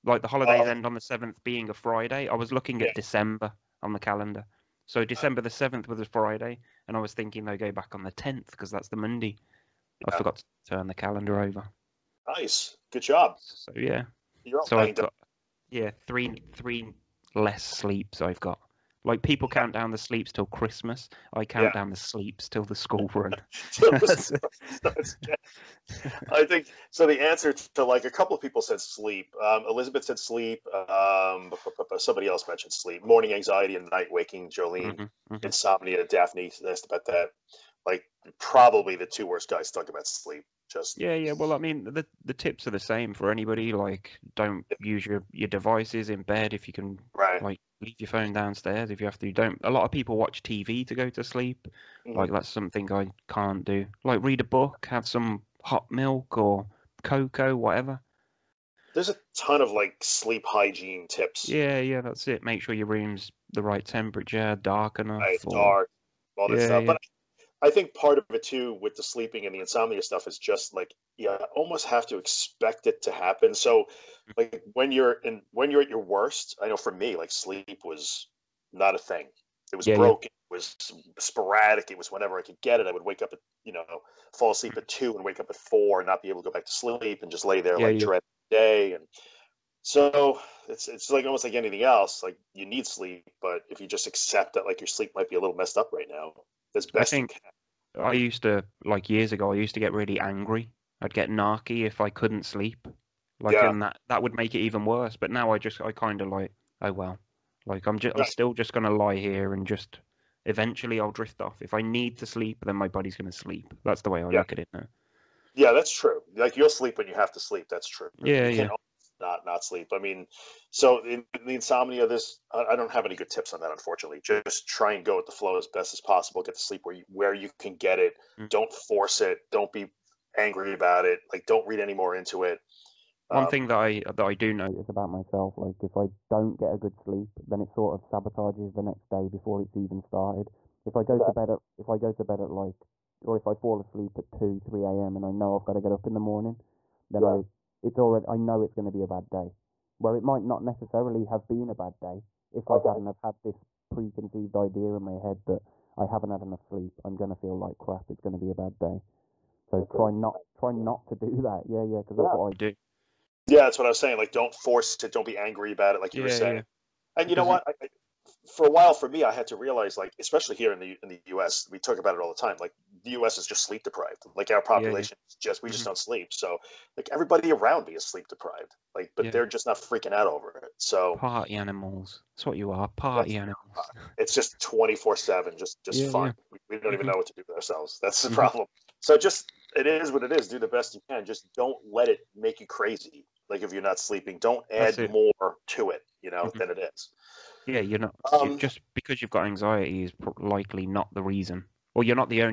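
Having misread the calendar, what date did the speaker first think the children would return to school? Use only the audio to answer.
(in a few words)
10th.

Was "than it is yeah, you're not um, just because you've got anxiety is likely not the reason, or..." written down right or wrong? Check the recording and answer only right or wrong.
right.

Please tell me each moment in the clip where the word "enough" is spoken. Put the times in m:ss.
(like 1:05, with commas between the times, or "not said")
1:04, 2:36.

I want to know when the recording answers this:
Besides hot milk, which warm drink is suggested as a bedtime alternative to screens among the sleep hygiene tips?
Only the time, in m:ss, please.
0:57.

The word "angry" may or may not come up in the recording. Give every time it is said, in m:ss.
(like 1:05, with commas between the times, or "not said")
1:40, 2:10, 2:45.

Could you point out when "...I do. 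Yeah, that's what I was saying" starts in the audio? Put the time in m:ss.
2:42.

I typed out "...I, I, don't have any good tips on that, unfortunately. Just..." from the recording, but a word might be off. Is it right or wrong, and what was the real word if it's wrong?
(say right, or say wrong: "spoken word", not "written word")
right.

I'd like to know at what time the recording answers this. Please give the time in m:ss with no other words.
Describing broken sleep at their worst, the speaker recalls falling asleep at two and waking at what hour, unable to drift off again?
1:25.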